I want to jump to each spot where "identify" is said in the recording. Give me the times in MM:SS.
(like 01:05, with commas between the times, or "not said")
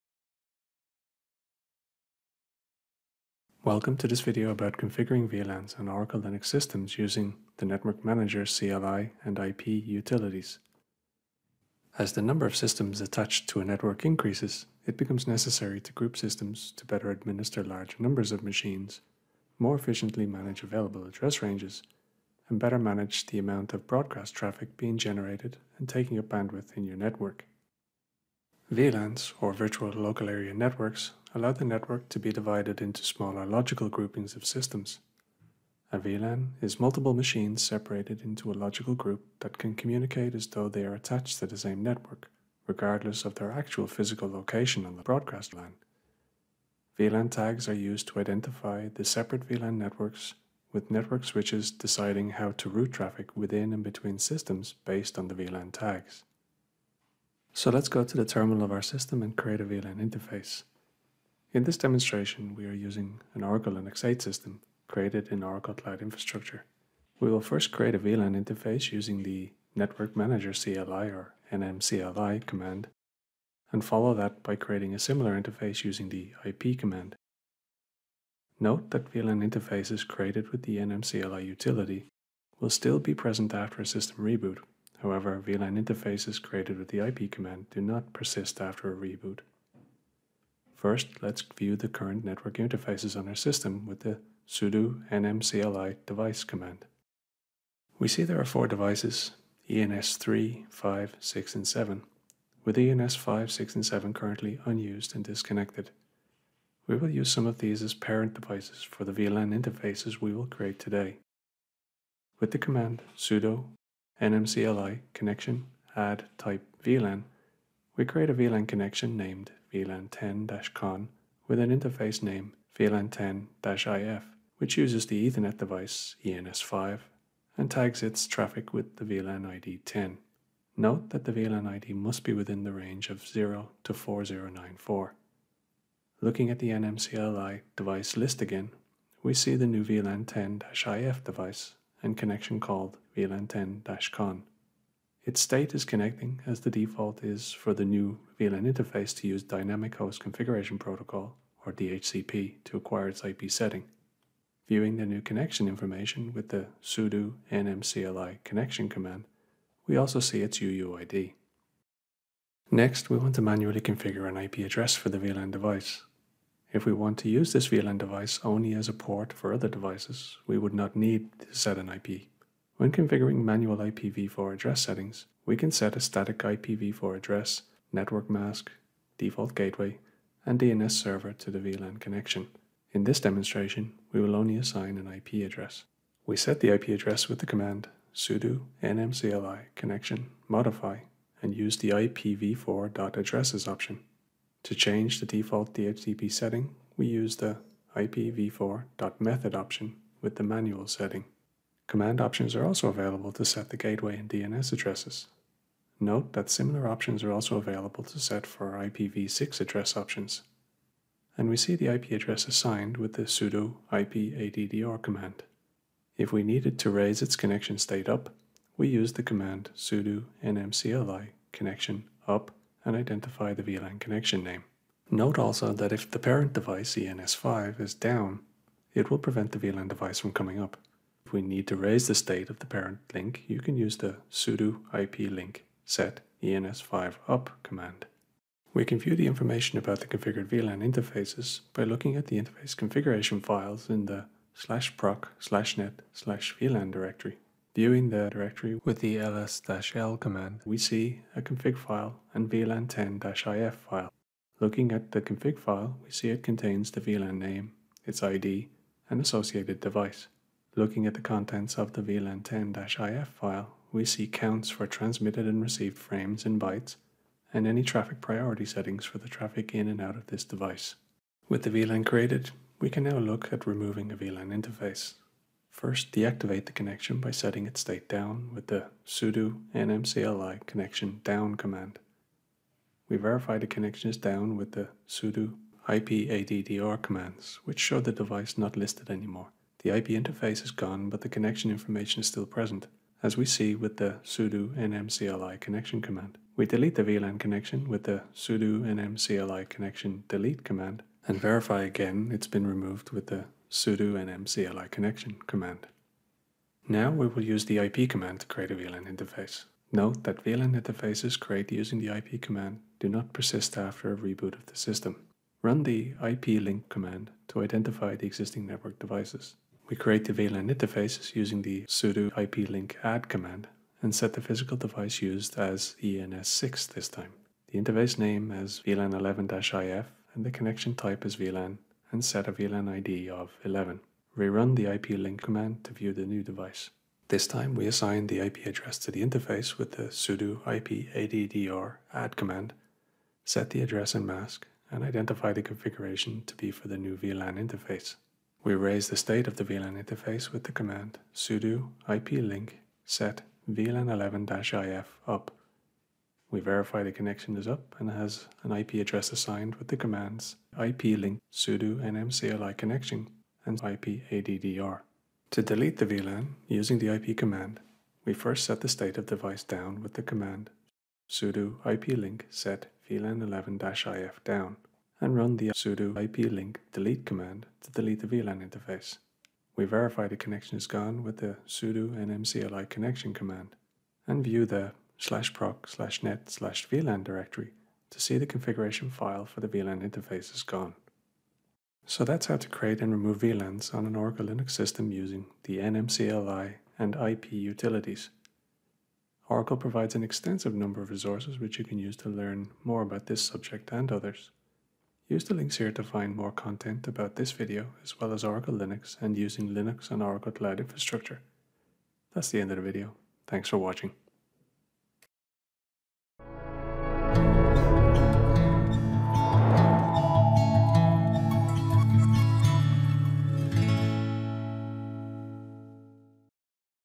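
00:48, 03:42, 05:17, 05:45.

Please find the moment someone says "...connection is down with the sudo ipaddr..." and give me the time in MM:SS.
04:43.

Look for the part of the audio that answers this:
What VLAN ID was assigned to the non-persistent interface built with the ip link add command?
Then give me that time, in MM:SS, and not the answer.
05:33.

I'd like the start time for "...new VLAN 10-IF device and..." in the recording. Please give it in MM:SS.
02:19.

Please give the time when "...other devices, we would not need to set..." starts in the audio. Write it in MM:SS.
02:49.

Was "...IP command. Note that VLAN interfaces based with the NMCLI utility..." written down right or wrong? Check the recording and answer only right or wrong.
wrong.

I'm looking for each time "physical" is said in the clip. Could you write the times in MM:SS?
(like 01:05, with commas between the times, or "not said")
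00:43, 05:24.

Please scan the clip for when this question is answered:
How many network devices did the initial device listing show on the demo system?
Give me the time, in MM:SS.
01:38.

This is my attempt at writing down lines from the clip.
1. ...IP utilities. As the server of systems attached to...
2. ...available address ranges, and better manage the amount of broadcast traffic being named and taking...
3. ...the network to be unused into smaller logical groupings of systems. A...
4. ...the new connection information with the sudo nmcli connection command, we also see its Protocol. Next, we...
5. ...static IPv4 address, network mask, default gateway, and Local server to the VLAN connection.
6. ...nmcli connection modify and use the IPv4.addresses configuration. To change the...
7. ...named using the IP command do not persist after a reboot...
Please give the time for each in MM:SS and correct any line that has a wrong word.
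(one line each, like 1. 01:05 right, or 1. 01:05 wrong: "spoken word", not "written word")
1. 00:09 wrong: "number", not "server"
2. 00:20 wrong: "generated", not "named"
3. 00:31 wrong: "divided", not "unused"
4. 02:34 wrong: "UUID", not "Protocol"
5. 02:55 wrong: "DNS", not "Local"
6. 03:08 wrong: "option", not "configuration"
7. 05:11 wrong: "created", not "named".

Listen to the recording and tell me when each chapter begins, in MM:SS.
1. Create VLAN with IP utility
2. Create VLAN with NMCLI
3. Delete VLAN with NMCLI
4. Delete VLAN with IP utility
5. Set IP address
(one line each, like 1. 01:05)
1. 05:06
2. 00:58
3. 04:30
4. 06:05
5. 02:43.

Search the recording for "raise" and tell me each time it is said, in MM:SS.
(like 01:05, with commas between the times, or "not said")
03:36, 03:51, 05:48.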